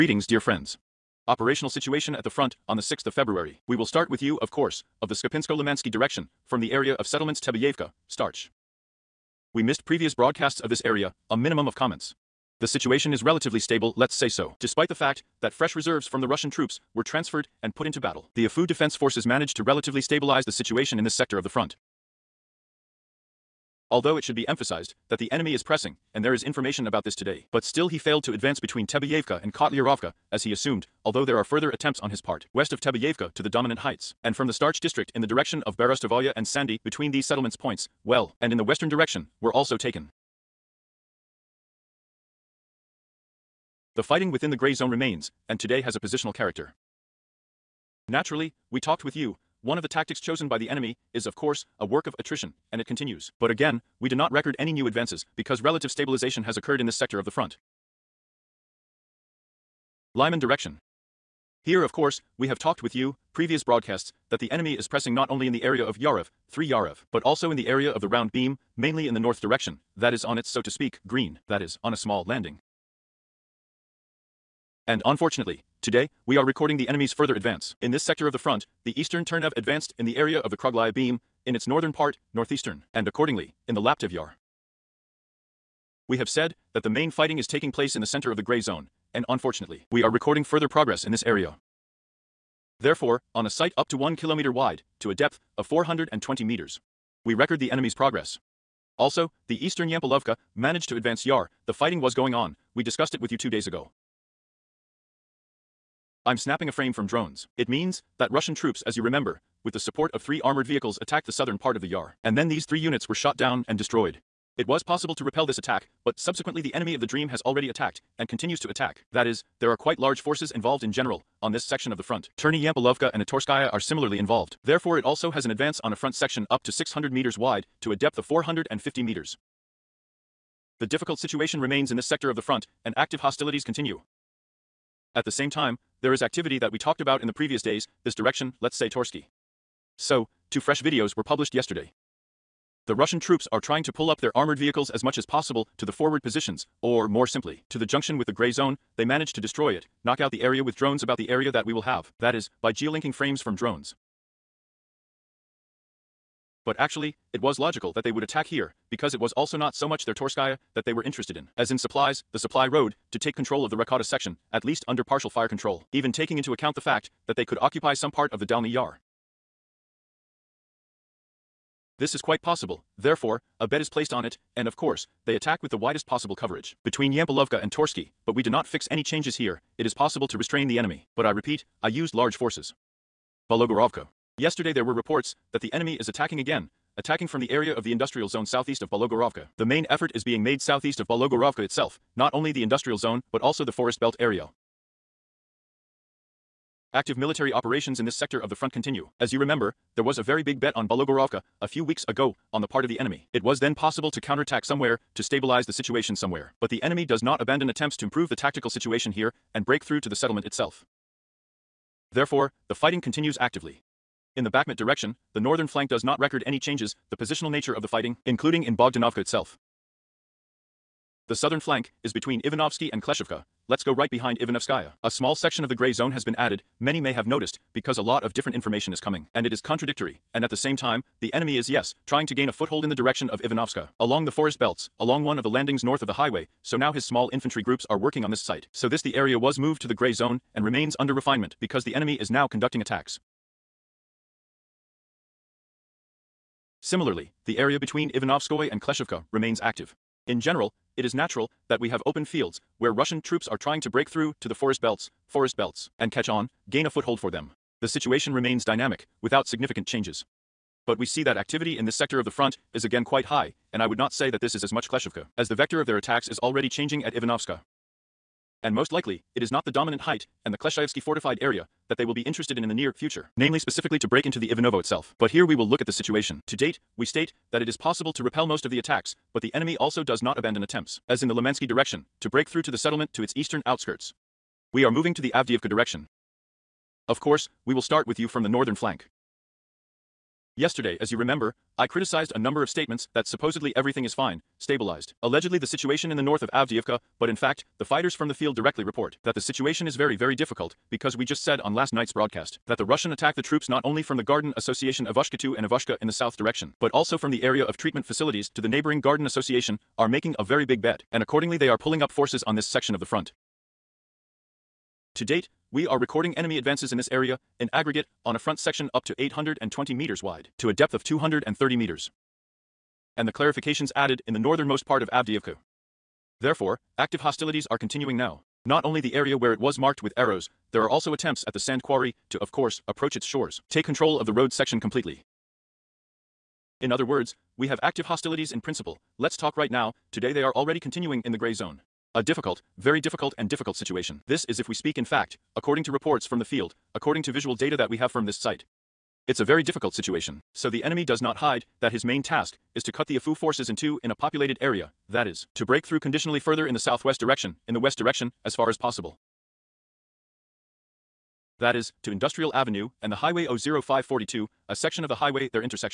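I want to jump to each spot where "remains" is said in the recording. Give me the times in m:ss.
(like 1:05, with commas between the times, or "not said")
0:44, 2:11, 4:00, 4:09, 4:18.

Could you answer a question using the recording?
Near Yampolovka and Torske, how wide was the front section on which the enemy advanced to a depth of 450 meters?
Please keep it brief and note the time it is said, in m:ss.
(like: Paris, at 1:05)
600 meters, at 2:06.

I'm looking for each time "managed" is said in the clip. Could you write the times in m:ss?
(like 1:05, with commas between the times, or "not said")
0:19, 1:40, 2:29.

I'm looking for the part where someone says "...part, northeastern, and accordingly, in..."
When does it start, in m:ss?
1:21.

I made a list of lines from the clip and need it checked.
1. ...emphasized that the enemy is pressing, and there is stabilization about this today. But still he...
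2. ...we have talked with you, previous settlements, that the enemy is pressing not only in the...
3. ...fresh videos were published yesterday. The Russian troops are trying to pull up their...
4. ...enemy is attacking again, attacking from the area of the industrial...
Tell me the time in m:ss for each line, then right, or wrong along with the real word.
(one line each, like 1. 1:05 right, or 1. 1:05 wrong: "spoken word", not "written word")
1. 0:24 wrong: "information", not "stabilization"
2. 1:02 wrong: "broadcasts", not "settlements"
3. 2:20 right
4. 3:05 right.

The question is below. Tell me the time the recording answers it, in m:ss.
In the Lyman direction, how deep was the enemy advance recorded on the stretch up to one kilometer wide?
1:35.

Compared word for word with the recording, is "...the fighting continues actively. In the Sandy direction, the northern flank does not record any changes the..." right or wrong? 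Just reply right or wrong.
wrong.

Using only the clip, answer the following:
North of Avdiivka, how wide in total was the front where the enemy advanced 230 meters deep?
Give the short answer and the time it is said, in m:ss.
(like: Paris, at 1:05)
820 meters, at 5:19.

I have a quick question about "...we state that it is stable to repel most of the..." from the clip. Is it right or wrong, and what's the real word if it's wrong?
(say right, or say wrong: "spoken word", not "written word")
wrong: "possible", not "stable".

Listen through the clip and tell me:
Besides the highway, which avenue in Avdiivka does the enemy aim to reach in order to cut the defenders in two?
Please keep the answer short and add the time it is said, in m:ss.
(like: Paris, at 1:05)
Industrial Avenue, at 6:02.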